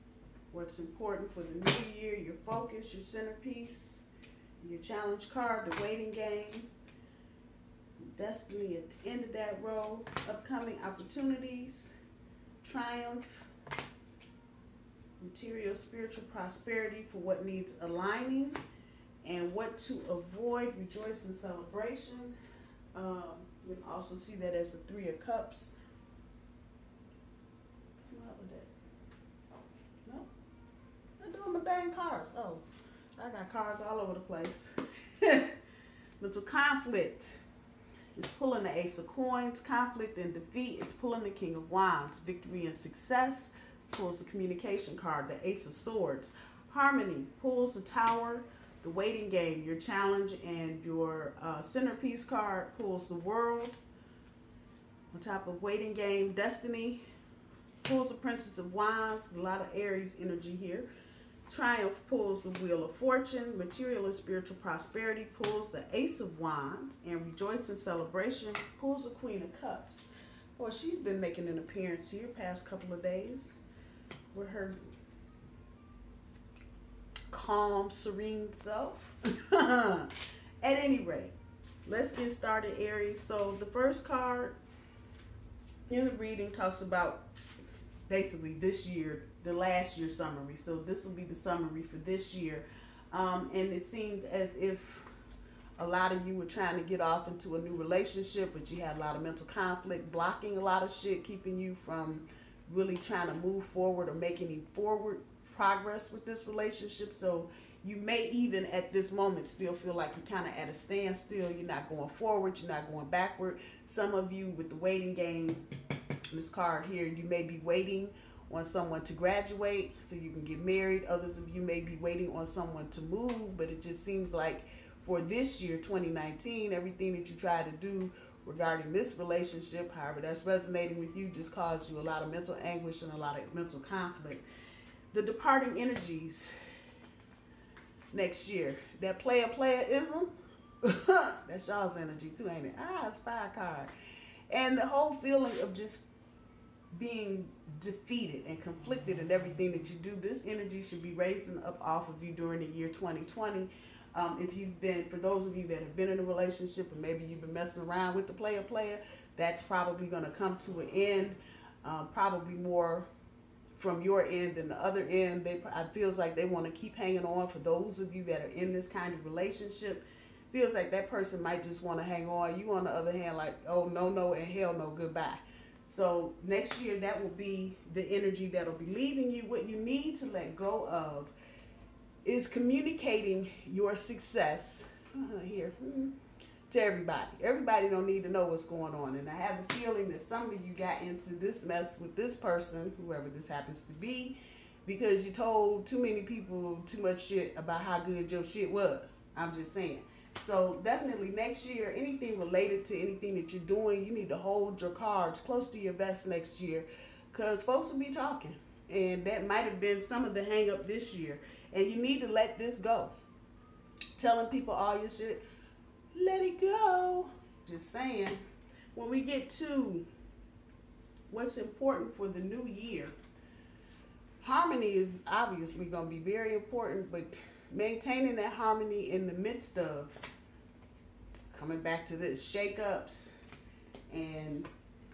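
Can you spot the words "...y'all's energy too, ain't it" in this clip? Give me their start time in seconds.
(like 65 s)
141 s.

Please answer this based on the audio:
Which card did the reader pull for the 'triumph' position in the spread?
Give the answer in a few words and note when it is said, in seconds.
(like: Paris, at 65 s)
Wheel of Fortune, at 62 s.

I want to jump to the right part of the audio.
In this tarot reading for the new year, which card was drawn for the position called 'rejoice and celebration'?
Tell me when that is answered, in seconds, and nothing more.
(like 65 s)
69 s.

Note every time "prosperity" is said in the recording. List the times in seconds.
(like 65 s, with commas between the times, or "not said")
16 s, 64 s.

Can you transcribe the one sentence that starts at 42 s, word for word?
Victory and success pulls the communication card, the ace of swords.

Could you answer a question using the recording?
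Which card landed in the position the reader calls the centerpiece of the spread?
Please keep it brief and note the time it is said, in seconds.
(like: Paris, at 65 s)
The World, at 53 s.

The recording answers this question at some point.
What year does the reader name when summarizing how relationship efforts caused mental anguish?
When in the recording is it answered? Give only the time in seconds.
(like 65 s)
125 s.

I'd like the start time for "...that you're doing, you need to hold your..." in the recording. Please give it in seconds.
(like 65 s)
203 s.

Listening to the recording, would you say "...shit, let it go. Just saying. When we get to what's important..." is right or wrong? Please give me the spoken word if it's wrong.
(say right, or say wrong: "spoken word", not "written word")
right.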